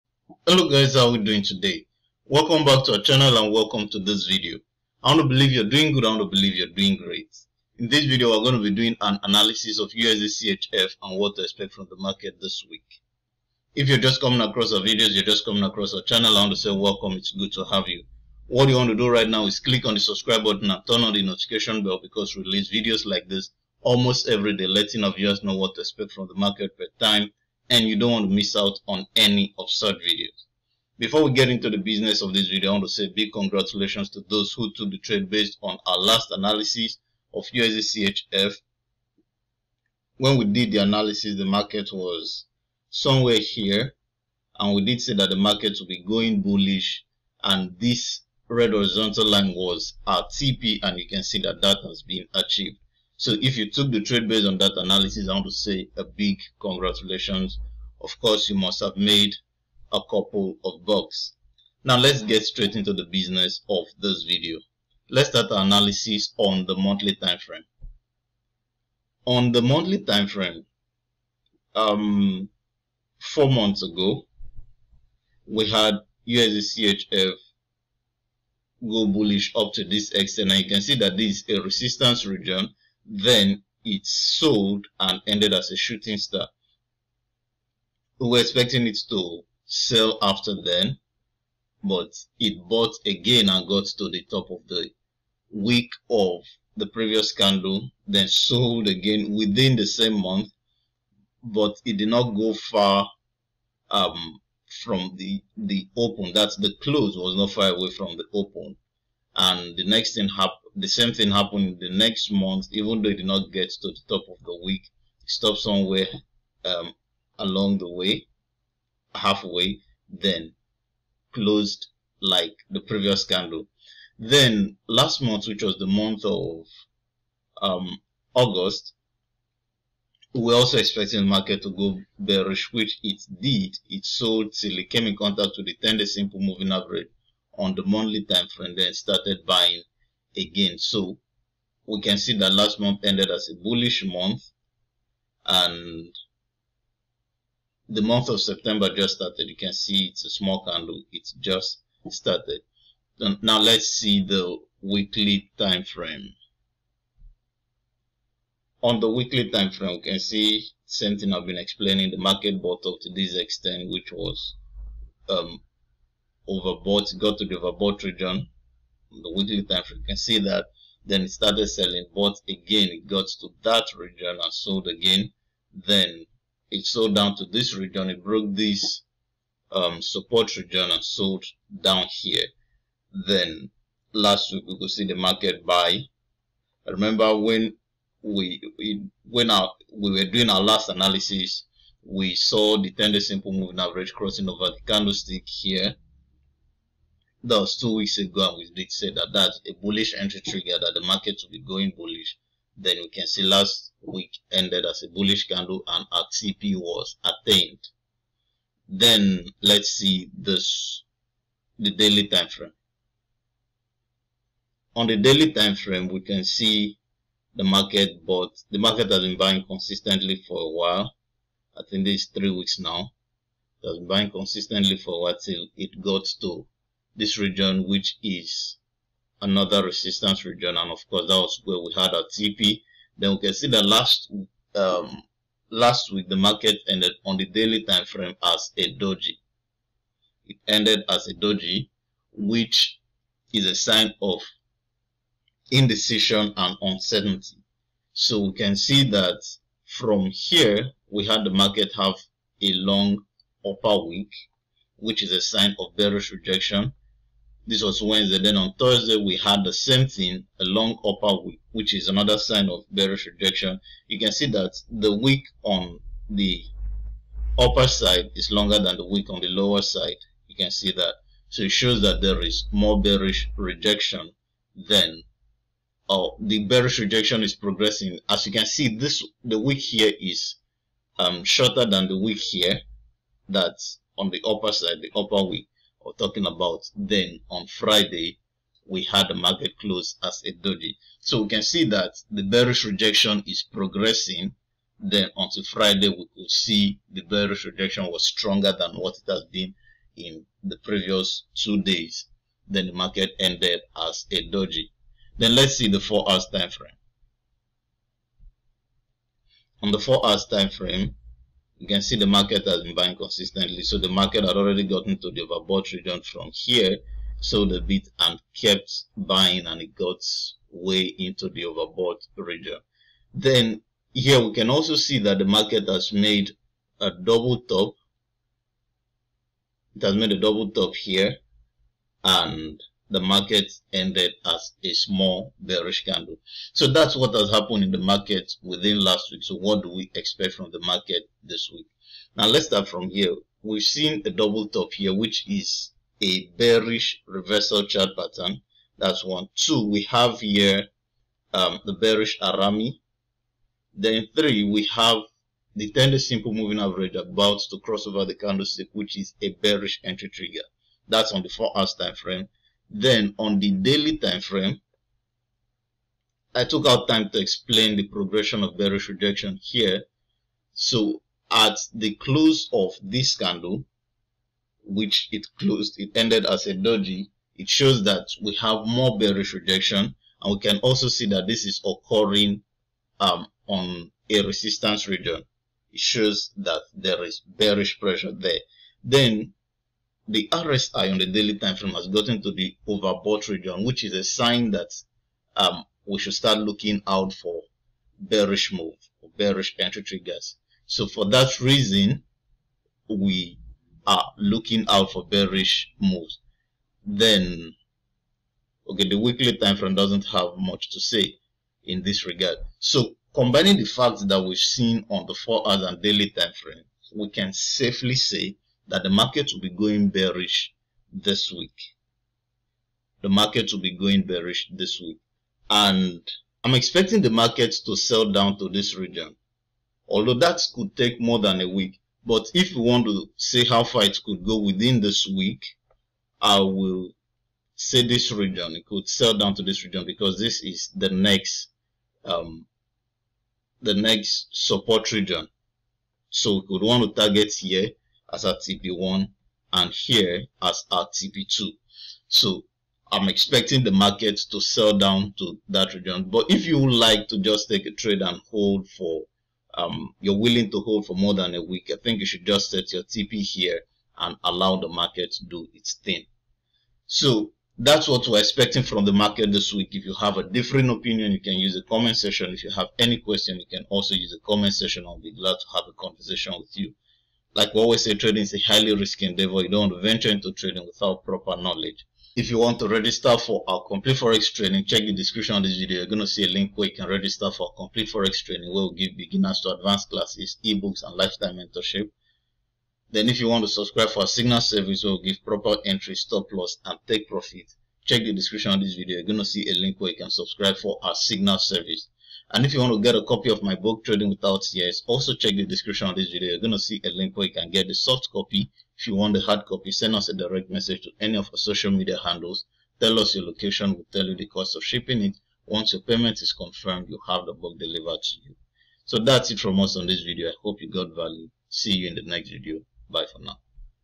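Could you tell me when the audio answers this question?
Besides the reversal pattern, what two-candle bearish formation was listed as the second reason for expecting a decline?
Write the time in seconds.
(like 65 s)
351 s.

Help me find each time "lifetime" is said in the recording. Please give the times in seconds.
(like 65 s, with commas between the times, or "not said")
491 s.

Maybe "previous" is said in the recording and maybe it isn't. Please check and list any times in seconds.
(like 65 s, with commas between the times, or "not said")
96 s, 122 s, 300 s.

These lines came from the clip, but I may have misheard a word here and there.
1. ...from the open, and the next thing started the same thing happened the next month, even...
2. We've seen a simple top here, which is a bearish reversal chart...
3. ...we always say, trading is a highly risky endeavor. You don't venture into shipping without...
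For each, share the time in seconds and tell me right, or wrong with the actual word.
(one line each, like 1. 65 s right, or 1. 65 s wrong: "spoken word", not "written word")
1. 107 s wrong: "happened", not "started"
2. 343 s wrong: "double", not "simple"
3. 477 s wrong: "trading", not "shipping".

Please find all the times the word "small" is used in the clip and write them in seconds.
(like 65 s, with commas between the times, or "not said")
150 s, 334 s.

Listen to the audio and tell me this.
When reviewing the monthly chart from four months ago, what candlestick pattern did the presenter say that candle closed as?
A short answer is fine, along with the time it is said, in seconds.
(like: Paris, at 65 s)
Shooting star, at 85 s.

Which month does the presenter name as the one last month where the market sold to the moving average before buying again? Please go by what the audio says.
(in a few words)
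August.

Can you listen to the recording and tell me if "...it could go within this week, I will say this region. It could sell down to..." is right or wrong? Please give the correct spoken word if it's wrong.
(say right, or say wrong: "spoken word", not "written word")
right.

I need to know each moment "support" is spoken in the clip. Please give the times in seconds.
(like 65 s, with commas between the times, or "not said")
180 s, 444 s.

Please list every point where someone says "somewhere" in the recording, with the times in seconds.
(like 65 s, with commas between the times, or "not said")
42 s, 115 s.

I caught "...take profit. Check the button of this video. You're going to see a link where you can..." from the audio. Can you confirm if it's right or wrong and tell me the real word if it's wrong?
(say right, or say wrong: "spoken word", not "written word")
wrong: "description", not "button".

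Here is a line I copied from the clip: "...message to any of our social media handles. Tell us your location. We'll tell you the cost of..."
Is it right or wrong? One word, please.
right.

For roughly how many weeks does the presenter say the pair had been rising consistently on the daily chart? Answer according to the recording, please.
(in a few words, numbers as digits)
3 weeks.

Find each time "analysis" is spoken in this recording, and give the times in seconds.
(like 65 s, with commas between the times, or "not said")
9 s, 36 s, 40 s, 54 s, 65 s, 190 s.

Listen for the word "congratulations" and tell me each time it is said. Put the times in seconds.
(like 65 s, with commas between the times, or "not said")
33 s, 56 s.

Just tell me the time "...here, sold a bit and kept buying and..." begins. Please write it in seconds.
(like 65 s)
316 s.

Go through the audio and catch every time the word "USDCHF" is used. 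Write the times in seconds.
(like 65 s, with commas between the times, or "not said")
37 s, 76 s.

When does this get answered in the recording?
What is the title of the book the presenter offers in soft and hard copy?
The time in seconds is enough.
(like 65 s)
504 s.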